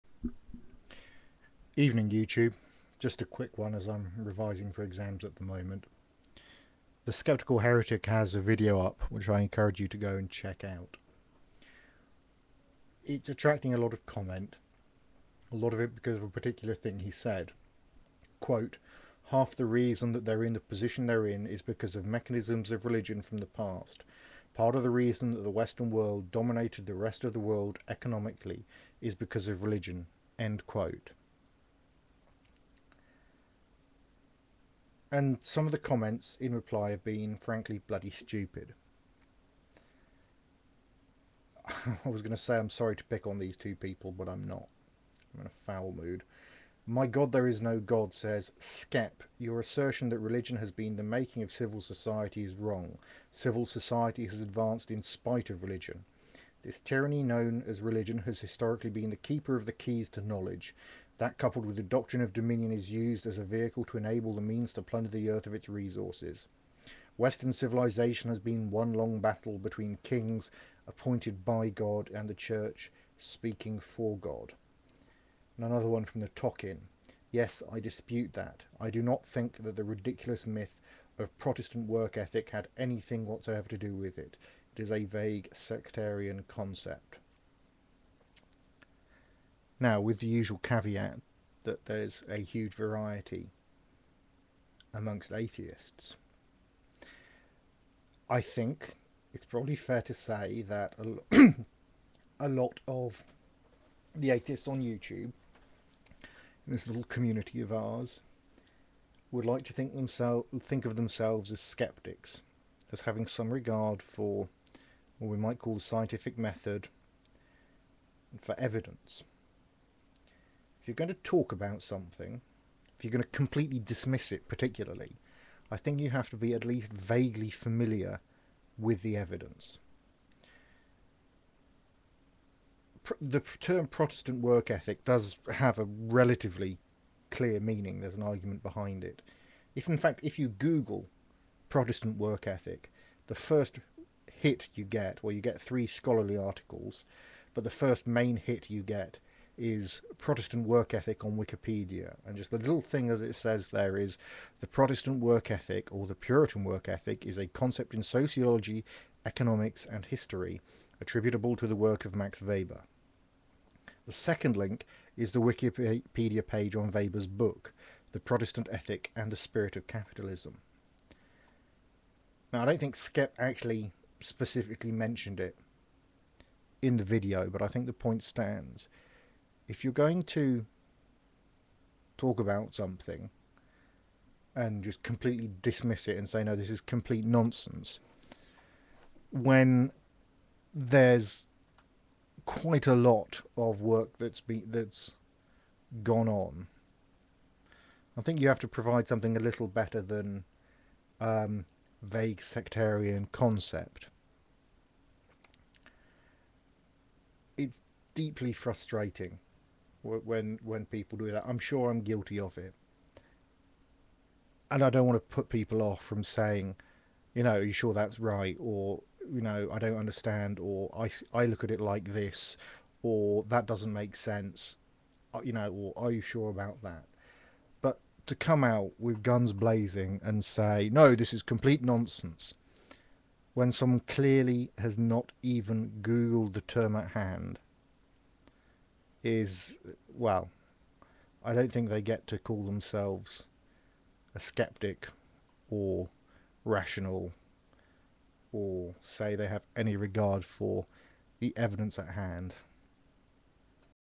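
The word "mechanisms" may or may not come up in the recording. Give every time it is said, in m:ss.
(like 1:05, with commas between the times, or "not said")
0:22.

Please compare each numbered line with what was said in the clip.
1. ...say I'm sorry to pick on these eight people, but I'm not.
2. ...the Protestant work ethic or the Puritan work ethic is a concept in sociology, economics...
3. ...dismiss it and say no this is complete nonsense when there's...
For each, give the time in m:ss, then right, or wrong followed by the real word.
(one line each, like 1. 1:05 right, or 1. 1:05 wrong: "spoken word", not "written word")
1. 0:42 wrong: "two", not "eight"
2. 2:34 right
3. 3:05 right.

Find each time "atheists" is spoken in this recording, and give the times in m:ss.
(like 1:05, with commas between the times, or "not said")
1:35, 1:44.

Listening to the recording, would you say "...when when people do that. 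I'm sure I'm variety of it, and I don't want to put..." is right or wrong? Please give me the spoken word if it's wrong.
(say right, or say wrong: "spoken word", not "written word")
wrong: "guilty", not "variety".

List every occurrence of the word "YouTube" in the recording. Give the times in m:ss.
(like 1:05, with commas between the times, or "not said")
0:02, 1:44.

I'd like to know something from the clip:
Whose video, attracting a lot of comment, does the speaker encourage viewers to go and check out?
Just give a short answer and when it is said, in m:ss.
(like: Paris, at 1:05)
The Skeptical Heretic, at 0:07.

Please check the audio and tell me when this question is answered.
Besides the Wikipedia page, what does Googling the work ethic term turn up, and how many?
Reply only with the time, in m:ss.
2:25.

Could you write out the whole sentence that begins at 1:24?
It is a vague sectarian concept.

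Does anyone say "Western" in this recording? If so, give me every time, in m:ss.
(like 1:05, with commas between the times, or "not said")
0:25, 1:07.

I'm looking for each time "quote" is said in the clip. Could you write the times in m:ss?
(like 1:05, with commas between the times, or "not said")
0:18, 0:30.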